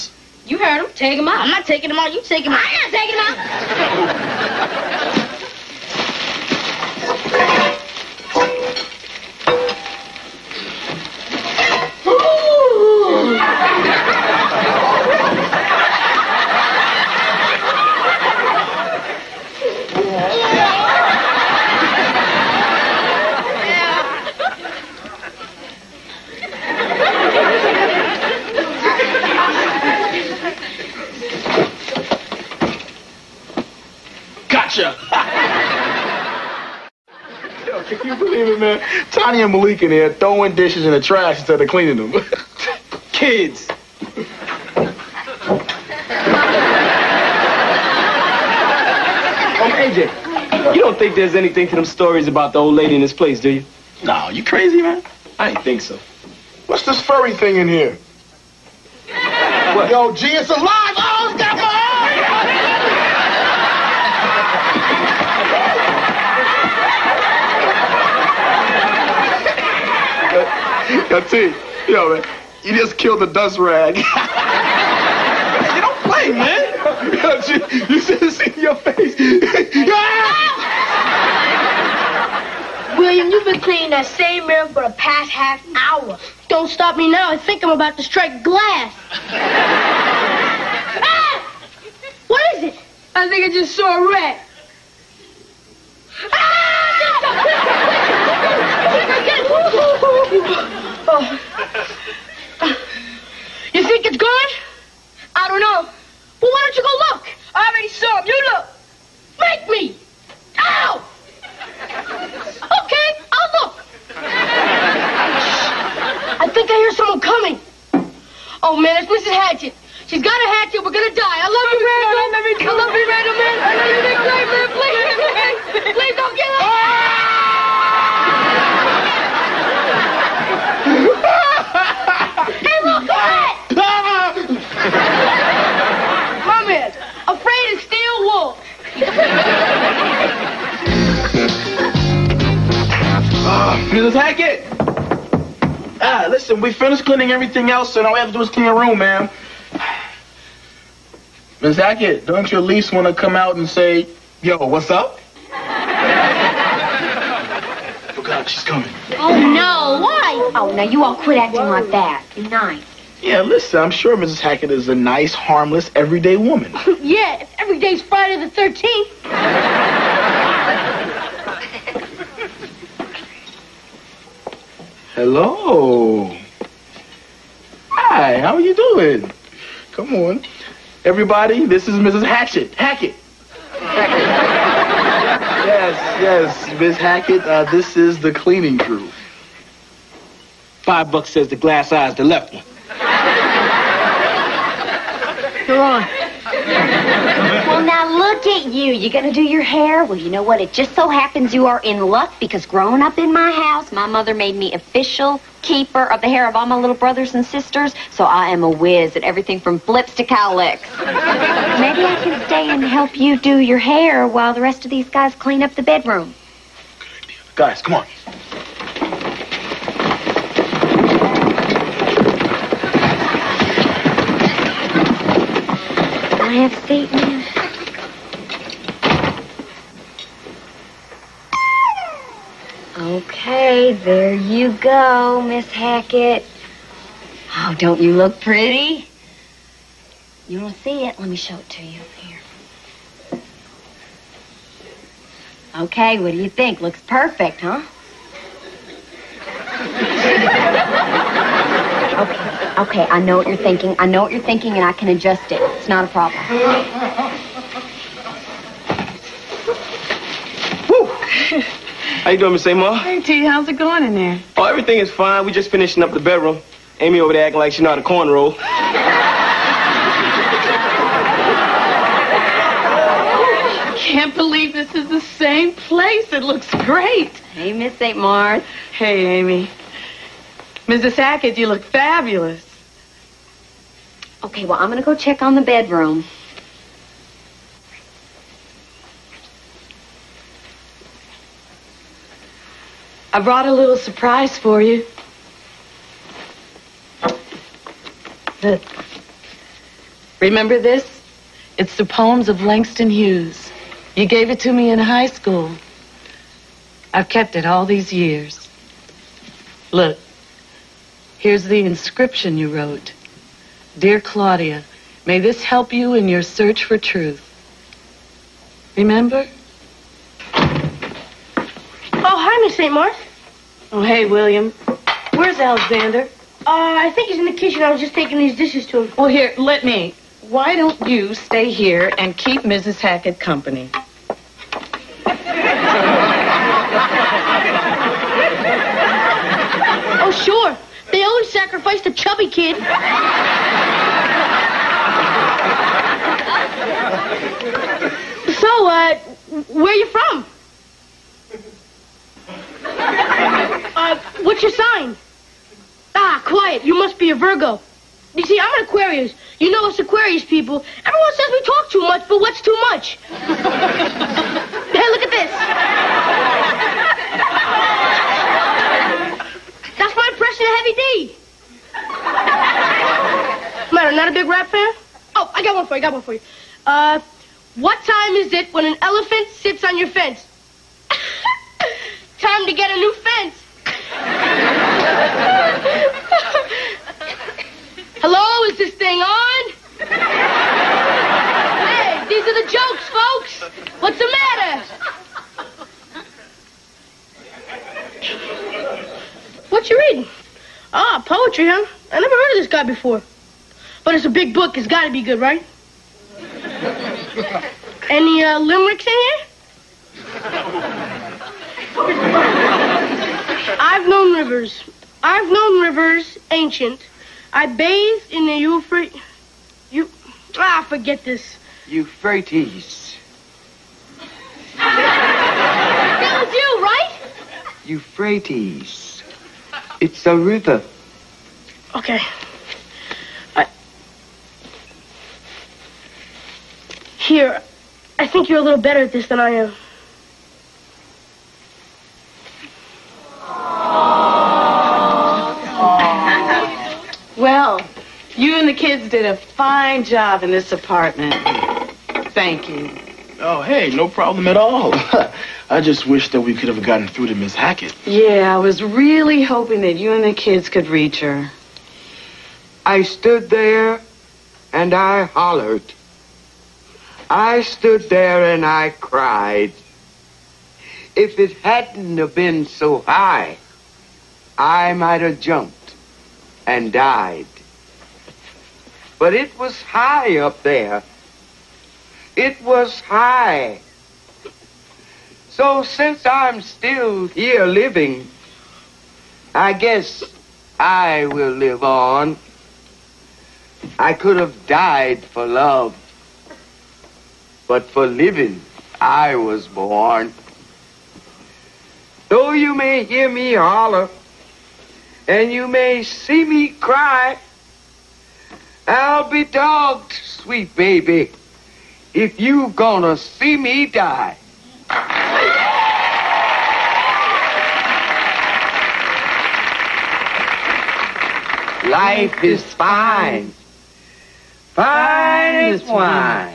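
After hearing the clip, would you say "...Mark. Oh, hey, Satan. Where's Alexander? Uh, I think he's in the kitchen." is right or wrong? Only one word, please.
wrong.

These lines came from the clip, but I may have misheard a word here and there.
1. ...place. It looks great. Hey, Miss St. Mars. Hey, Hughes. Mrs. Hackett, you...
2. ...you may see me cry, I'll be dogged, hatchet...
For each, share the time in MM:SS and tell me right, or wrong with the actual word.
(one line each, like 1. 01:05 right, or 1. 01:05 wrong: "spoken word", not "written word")
1. 04:35 wrong: "Amy", not "Hughes"
2. 08:25 wrong: "sweet", not "hatchet".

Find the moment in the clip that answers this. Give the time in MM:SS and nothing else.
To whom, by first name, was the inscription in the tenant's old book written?
05:14.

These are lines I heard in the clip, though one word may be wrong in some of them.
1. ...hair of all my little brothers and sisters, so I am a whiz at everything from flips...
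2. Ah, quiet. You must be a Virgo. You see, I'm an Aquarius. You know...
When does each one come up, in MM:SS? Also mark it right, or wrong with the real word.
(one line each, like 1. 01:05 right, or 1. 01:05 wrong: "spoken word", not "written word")
1. 03:26 right
2. 05:56 right.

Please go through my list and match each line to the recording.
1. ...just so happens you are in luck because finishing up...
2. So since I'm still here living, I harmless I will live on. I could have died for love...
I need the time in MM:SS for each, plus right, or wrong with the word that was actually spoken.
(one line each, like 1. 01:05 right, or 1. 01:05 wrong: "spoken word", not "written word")
1. 03:20 wrong: "growing", not "finishing"
2. 08:05 wrong: "guess", not "harmless".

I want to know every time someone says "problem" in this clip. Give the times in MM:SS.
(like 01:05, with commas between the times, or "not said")
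04:16, 07:34.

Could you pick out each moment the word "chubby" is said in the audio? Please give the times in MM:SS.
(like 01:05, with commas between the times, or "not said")
05:42.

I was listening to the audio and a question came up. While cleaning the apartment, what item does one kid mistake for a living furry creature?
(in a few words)
The dust rag.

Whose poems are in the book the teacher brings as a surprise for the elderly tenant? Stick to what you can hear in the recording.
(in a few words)
Langston Hughes.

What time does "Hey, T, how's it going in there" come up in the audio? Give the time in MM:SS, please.
04:22.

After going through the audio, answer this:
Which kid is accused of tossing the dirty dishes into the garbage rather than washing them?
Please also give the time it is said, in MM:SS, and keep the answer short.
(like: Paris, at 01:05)
Malik, at 00:39.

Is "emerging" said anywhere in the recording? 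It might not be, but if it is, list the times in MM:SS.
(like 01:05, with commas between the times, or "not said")
not said.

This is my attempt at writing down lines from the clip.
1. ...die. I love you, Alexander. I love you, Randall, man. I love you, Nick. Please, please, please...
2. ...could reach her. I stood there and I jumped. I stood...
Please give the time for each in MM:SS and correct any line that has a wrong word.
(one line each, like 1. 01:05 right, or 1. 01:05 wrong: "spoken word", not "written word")
1. 02:01 wrong: "Randall", not "Alexander"
2. 07:40 wrong: "hollered", not "jumped".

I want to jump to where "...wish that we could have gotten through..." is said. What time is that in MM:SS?
07:36.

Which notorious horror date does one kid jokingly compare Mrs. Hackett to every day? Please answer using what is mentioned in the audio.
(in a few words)
Friday the 13th.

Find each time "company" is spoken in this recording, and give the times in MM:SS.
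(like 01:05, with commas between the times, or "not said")
05:33.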